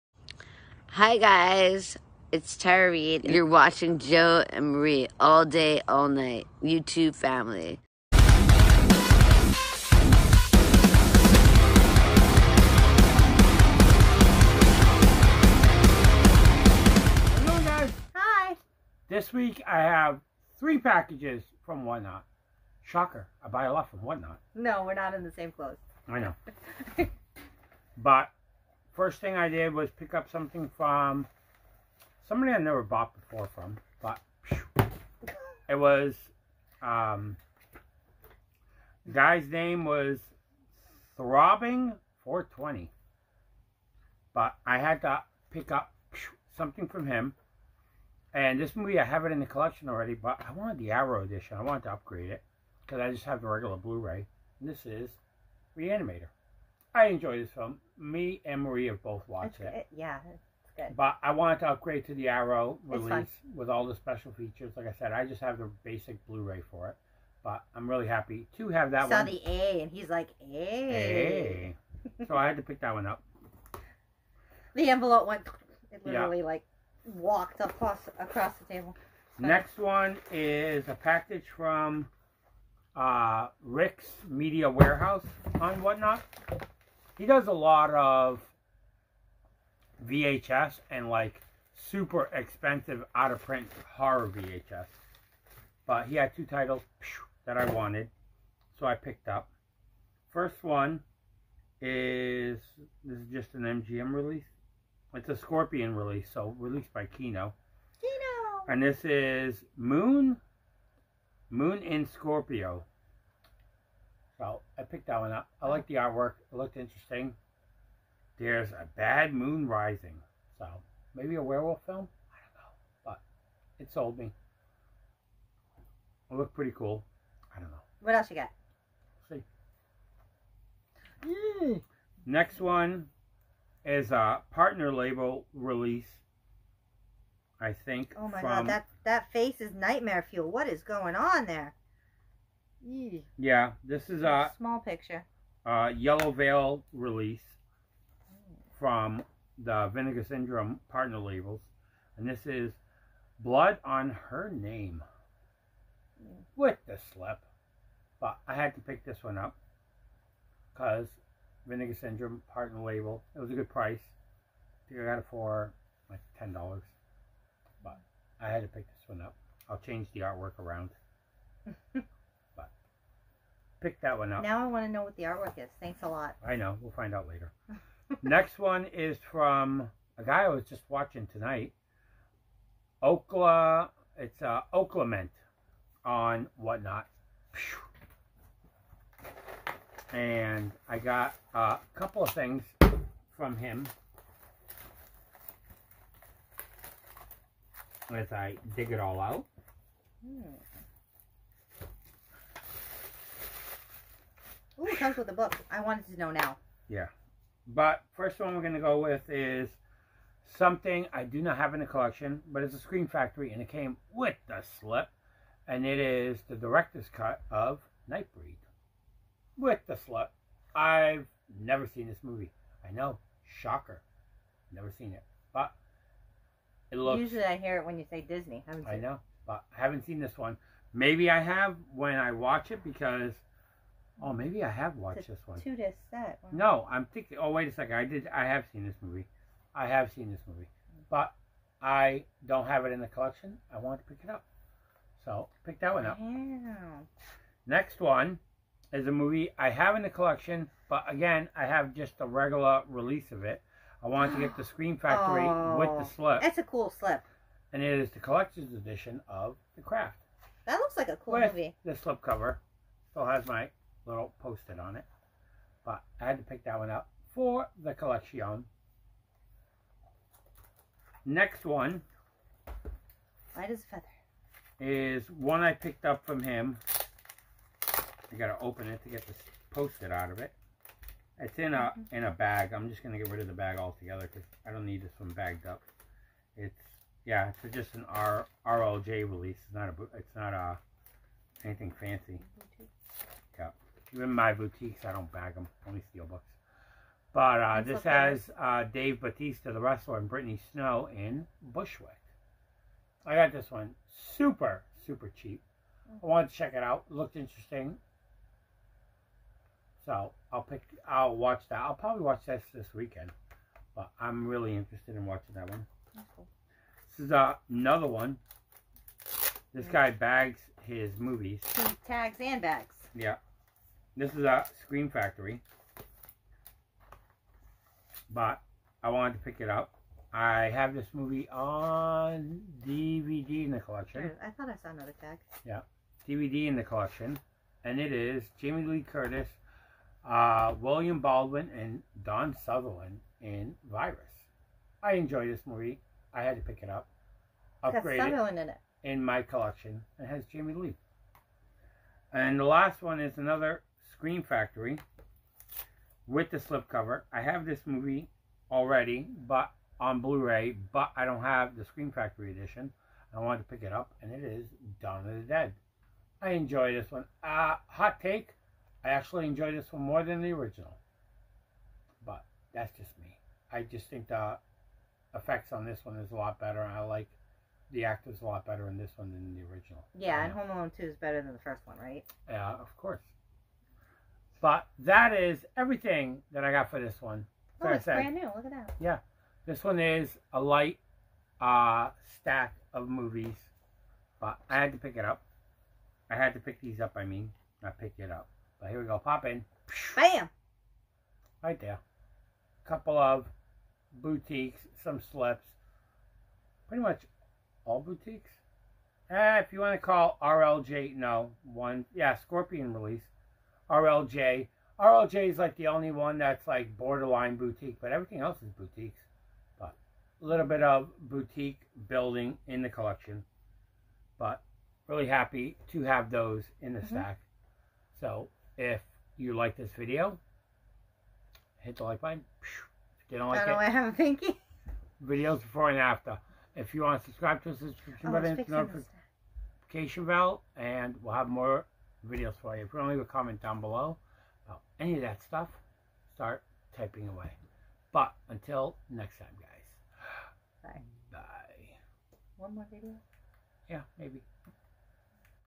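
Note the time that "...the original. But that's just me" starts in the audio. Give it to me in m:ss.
6:10.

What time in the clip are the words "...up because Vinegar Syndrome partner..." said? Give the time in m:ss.
2:39.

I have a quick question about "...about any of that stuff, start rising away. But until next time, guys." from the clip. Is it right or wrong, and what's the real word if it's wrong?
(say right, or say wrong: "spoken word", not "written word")
wrong: "typing", not "rising".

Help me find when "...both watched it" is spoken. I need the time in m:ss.
0:59.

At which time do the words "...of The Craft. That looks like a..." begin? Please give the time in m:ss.
4:19.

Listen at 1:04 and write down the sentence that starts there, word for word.
Like I said, I just have the basic Blu-ray for it.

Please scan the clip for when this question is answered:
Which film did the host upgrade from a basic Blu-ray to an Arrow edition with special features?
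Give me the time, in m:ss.
0:55.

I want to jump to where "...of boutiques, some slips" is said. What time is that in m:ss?
6:43.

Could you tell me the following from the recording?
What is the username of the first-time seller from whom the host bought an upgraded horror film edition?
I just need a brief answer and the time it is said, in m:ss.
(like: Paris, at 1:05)
Throbbing420, at 0:41.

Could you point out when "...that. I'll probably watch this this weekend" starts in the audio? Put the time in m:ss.
5:11.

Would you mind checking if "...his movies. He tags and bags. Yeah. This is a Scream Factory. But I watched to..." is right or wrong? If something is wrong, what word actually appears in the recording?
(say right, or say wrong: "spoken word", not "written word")
wrong: "wanted", not "watched".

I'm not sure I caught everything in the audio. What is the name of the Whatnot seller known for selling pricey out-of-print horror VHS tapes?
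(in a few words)
Rick's Media Warehouse.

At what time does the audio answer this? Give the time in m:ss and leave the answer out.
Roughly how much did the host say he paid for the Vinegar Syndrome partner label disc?
2:46.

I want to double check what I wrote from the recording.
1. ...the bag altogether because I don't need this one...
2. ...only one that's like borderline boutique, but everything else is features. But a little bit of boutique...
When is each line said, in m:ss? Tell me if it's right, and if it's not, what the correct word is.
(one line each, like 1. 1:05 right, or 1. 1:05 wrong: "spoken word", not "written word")
1. 4:43 right
2. 6:55 wrong: "boutiques", not "features".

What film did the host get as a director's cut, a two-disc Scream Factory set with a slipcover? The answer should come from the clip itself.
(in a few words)
Nightbreed.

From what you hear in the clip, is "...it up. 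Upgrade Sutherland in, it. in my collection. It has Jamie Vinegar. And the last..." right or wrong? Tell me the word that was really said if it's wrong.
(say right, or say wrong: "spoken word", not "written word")
wrong: "Lee", not "Vinegar".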